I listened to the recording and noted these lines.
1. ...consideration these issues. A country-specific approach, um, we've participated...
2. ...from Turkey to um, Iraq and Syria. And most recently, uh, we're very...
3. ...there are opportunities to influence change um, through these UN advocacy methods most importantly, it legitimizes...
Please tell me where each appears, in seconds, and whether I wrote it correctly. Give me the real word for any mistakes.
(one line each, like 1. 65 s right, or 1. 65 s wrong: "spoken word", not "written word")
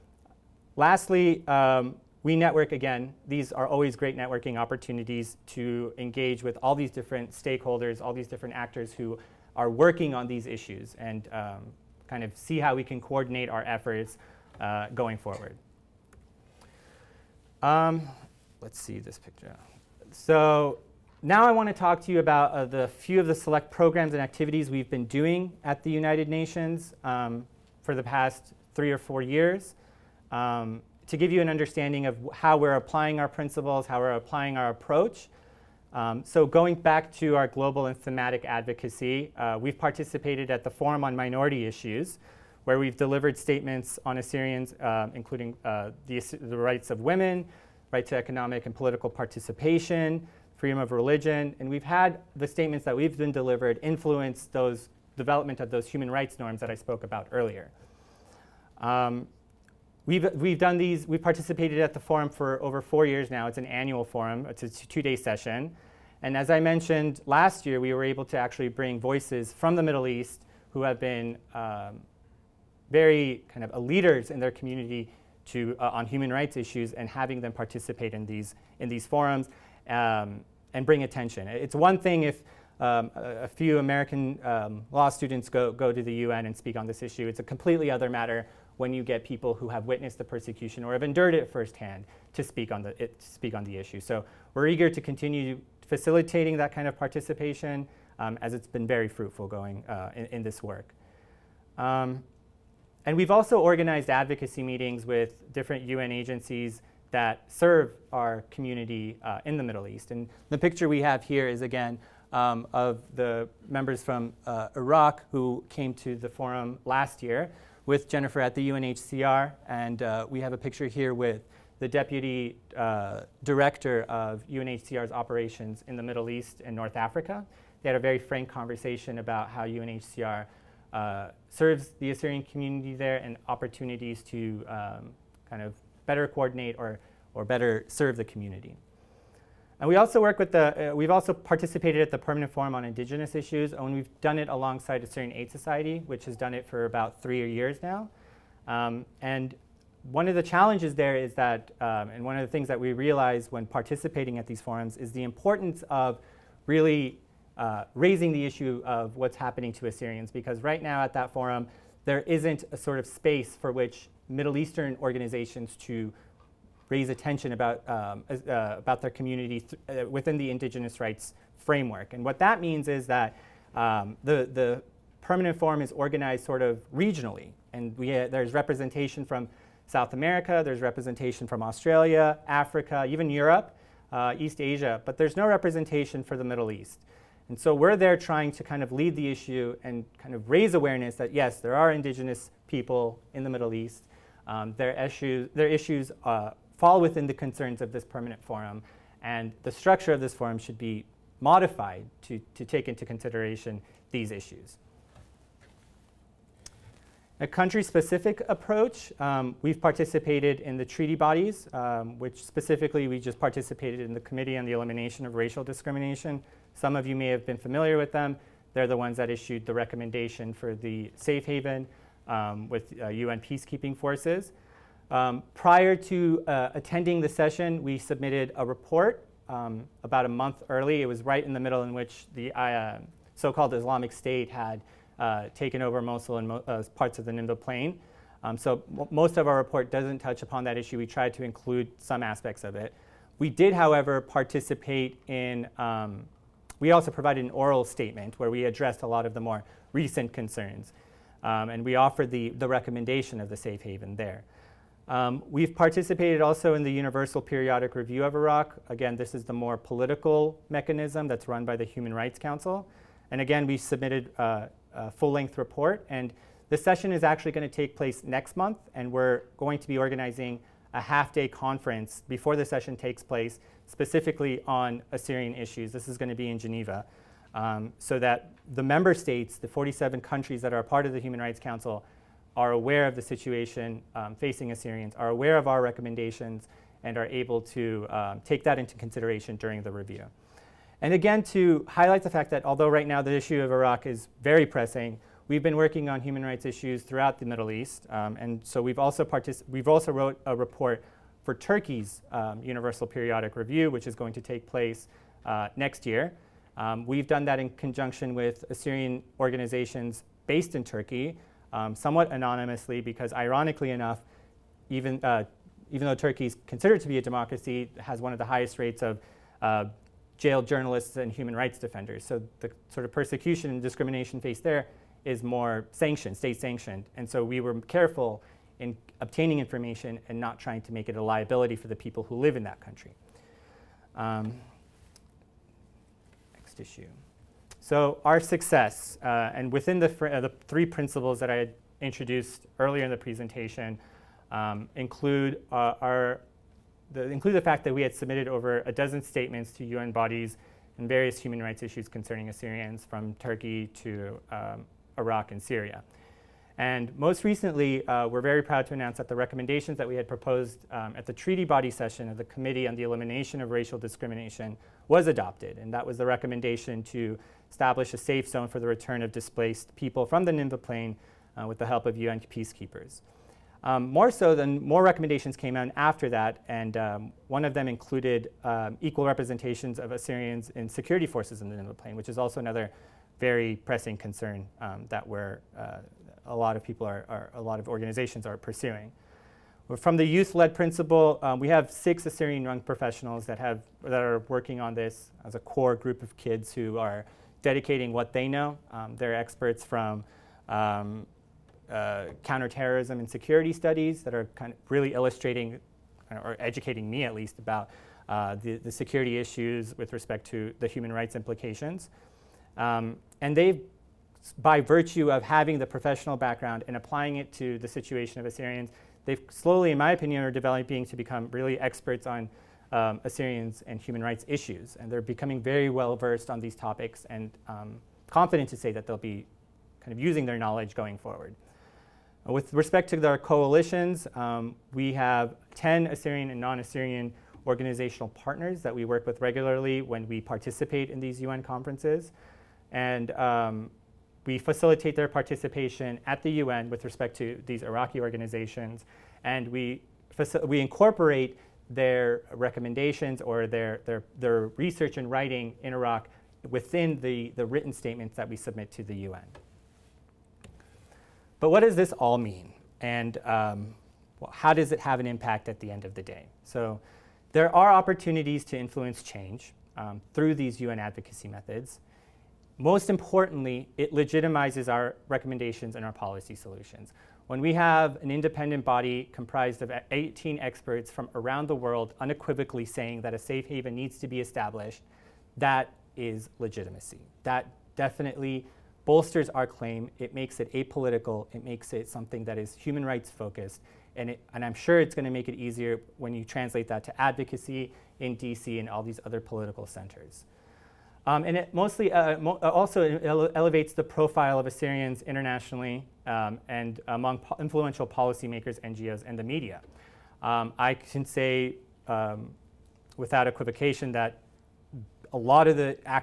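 1. 203 s right
2. 353 s right
3. 467 s right.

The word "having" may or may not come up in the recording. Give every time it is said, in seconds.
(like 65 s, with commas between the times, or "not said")
77 s, 415 s.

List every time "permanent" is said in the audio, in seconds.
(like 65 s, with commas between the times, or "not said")
142 s, 175 s, 198 s.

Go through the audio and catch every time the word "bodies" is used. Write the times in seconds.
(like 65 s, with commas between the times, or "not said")
211 s, 350 s.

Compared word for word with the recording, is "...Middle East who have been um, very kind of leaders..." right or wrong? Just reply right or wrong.
right.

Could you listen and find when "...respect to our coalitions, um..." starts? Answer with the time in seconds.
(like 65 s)
432 s.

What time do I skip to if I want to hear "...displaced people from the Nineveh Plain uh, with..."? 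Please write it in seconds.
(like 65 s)
369 s.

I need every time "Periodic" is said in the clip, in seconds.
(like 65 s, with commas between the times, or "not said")
257 s, 303 s.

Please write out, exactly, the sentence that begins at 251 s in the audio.
Um, and we offered the, the recommendation of the safe haven there.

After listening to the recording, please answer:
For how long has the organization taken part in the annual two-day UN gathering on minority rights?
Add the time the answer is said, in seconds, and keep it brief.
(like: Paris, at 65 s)
over 4 years, at 62 s.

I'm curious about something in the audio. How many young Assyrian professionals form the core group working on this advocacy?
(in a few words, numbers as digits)
6.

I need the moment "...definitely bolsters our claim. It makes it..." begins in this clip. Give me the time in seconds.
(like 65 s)
487 s.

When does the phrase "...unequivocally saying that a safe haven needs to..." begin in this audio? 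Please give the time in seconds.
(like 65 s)
482 s.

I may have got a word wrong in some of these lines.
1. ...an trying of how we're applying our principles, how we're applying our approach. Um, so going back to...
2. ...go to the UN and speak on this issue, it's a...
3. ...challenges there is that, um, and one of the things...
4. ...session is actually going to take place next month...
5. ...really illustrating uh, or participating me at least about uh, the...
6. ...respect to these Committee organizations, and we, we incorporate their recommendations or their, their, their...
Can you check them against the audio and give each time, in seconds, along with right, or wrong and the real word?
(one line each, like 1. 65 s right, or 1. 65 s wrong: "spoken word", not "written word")
1. 31 s wrong: "understanding", not "trying"
2. 85 s right
3. 150 s right
4. 266 s right
5. 404 s wrong: "educating", not "participating"
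6. 447 s wrong: "Iraqi", not "Committee".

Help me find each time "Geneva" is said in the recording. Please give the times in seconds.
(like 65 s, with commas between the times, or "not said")
276 s.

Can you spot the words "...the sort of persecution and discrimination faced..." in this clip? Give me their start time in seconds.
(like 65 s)
322 s.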